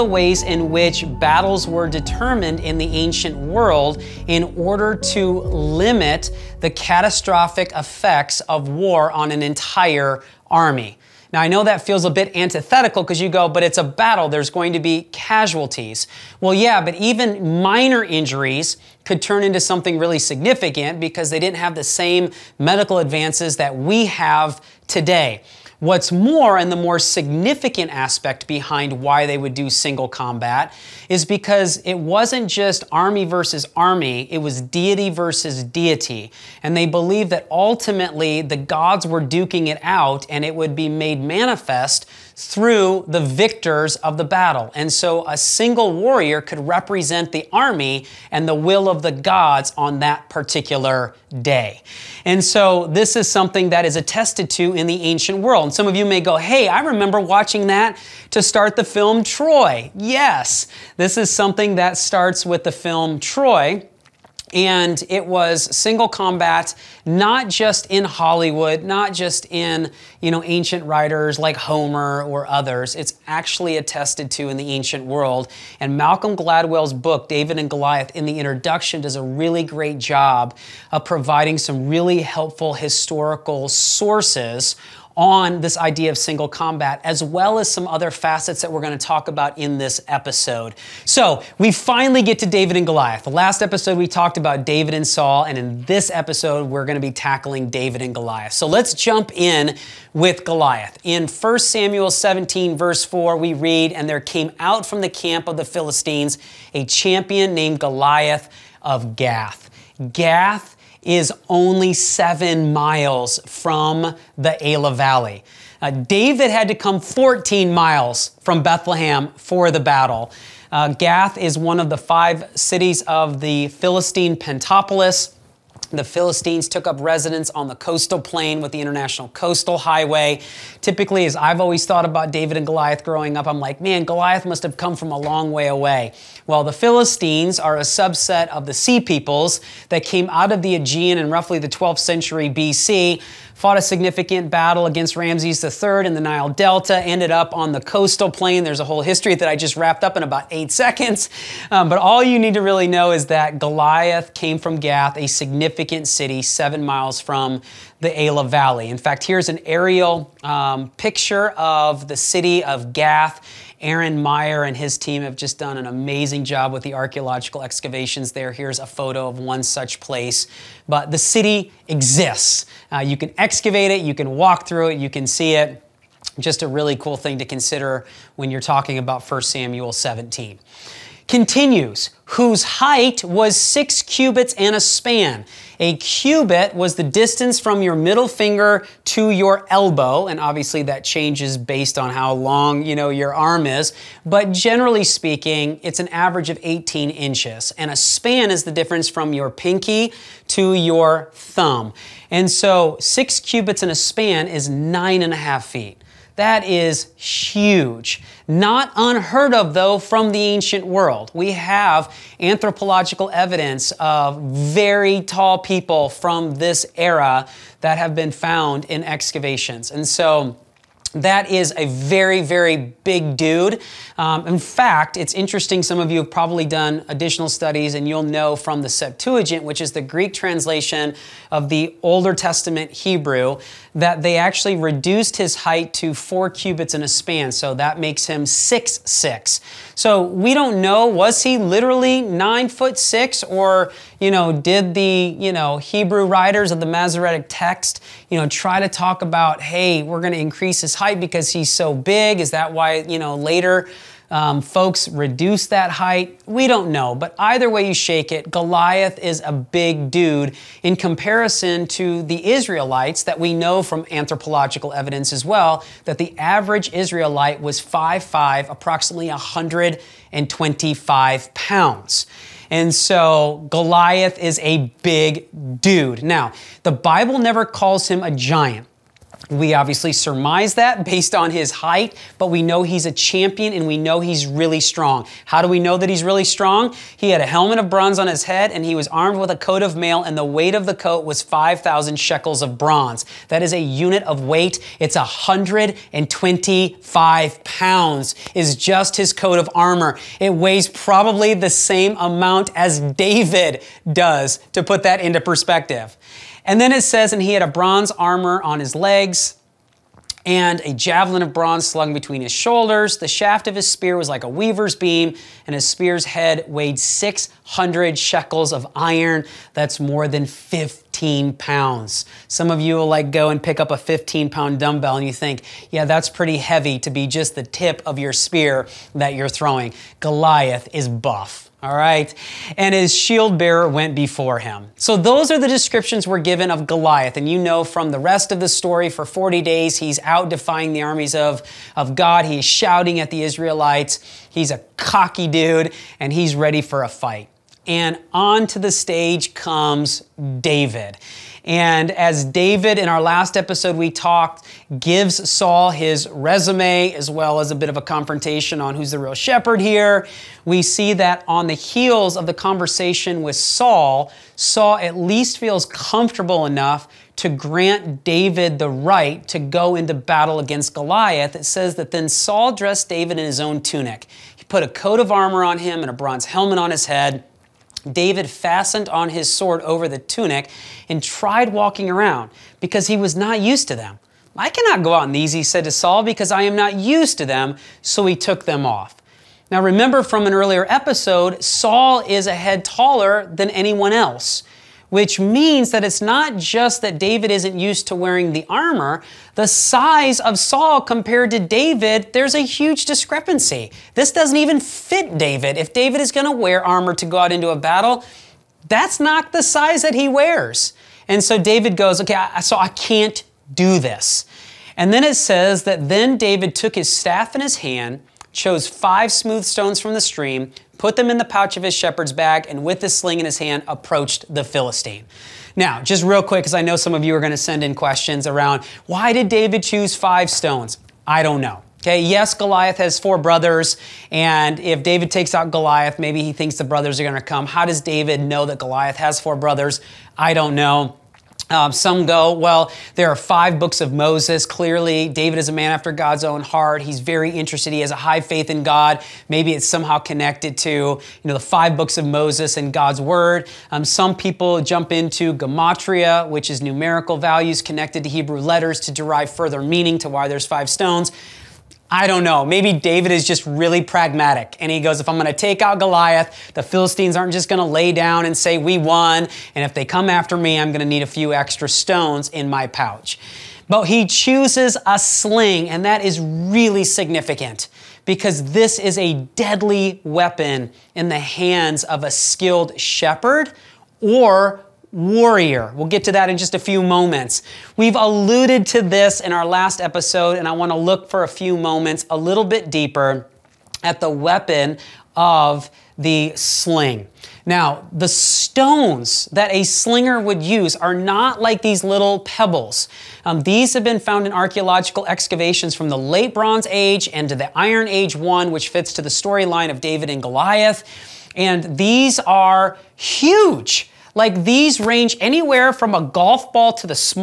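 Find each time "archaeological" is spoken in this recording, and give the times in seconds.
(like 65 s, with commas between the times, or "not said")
166 s, 504 s.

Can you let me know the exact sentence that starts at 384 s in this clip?
I cannot go out in these, he said to Saul, because I am not used to them.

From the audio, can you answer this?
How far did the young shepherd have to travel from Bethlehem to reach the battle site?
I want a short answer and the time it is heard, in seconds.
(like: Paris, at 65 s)
14 miles, at 116 s.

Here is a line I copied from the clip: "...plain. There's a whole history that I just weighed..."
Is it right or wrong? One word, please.
wrong.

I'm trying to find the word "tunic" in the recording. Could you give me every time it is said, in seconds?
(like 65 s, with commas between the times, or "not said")
373 s, 380 s.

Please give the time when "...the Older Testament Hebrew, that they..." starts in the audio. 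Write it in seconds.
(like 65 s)
231 s.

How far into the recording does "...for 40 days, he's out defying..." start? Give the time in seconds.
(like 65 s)
339 s.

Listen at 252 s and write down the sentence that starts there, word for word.
Is that why, you know, later um, folks reduce that height?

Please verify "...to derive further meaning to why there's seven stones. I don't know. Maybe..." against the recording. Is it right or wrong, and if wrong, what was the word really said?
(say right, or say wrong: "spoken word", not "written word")
wrong: "five", not "seven".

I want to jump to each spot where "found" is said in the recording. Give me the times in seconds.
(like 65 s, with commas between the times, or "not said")
218 s, 504 s.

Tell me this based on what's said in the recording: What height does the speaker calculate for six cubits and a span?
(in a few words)
9.5 feet.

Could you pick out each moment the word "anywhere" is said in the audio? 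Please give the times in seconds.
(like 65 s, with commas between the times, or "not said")
515 s.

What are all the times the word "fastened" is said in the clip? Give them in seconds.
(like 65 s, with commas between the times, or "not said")
378 s.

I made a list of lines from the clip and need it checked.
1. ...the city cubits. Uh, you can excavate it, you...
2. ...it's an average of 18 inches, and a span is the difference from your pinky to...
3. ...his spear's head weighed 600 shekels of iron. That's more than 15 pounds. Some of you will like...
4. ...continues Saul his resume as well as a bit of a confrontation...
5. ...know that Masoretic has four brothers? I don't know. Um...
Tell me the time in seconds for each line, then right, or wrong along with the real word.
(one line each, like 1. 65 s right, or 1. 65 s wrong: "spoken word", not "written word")
1. 171 s wrong: "exists", not "cubits"
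2. 195 s right
3. 315 s right
4. 355 s wrong: "gives", not "continues"
5. 438 s wrong: "Goliath", not "Masoretic".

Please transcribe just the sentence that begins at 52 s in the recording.
And so this is something that is attested to in the ancient world.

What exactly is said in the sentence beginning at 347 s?
And onto the stage comes David.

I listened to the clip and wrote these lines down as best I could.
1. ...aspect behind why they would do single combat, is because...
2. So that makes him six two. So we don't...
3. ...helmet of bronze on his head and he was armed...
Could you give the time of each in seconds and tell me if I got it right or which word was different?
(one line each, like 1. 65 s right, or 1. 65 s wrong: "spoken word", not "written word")
1. 27 s right
2. 237 s wrong: "six", not "two"
3. 287 s right.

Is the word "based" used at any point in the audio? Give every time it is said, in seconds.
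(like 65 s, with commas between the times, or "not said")
191 s, 281 s.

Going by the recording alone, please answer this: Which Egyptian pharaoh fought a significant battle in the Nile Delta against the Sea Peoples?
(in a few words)
Ramses III.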